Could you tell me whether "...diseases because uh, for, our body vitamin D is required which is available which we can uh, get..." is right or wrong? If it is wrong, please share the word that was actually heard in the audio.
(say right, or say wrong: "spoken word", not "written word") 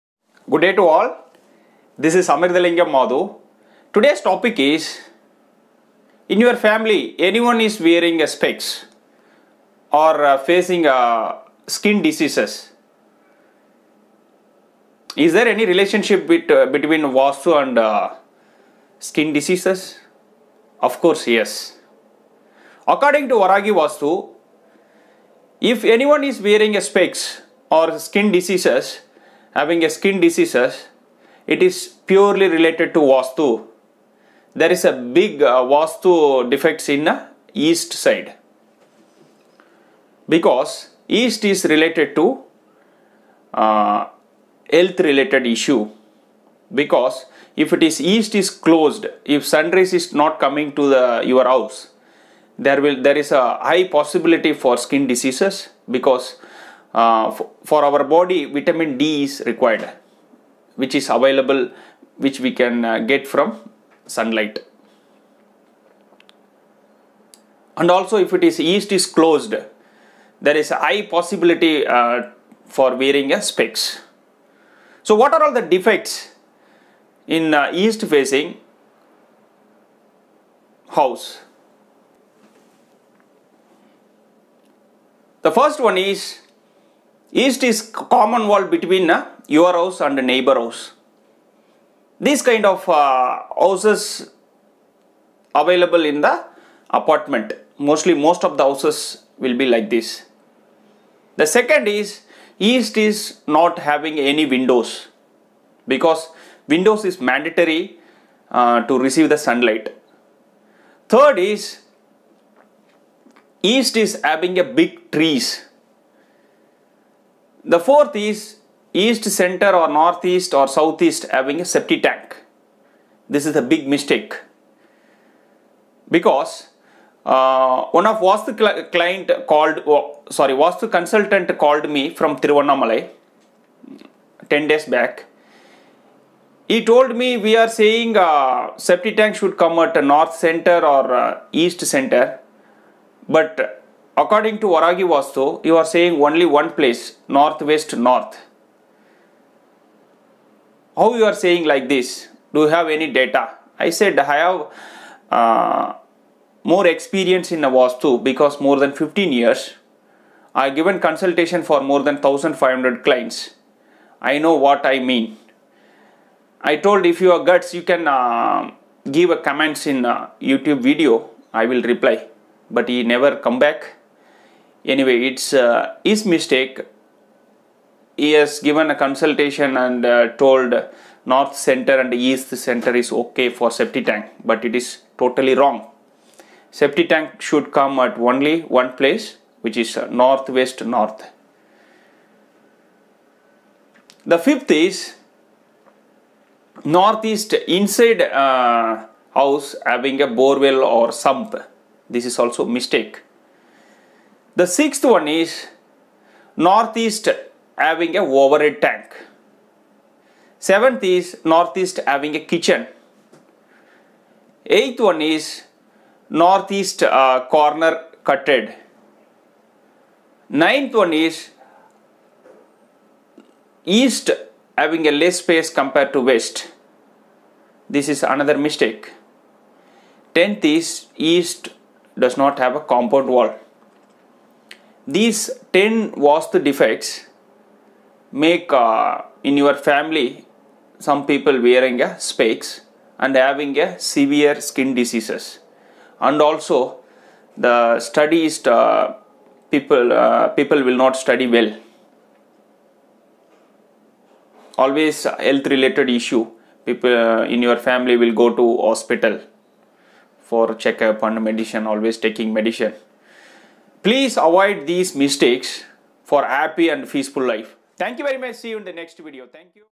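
right.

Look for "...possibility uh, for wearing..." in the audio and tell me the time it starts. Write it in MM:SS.
01:11.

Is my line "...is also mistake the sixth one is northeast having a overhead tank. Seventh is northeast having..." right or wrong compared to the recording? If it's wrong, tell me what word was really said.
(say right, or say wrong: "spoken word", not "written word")
right.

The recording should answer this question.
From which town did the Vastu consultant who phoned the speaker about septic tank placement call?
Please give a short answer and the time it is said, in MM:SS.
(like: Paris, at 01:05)
Tiruvannamalai, at 02:12.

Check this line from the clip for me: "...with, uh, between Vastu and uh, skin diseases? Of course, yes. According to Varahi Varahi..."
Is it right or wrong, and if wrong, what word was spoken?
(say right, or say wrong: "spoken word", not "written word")
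wrong: "Vastu", not "Varahi".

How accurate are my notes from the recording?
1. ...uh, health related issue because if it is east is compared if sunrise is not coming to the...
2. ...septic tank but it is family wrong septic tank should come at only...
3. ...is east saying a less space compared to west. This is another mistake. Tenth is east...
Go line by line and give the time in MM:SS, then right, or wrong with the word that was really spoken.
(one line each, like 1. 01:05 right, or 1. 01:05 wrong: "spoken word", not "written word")
1. 00:43 wrong: "closed", not "compared"
2. 03:03 wrong: "totally", not "family"
3. 03:41 wrong: "having", not "saying".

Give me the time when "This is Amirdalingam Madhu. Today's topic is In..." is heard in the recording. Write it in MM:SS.
00:02.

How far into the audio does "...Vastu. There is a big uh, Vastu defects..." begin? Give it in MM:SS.
00:33.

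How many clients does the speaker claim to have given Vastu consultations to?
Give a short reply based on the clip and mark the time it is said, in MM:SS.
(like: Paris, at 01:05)
1500, at 02:42.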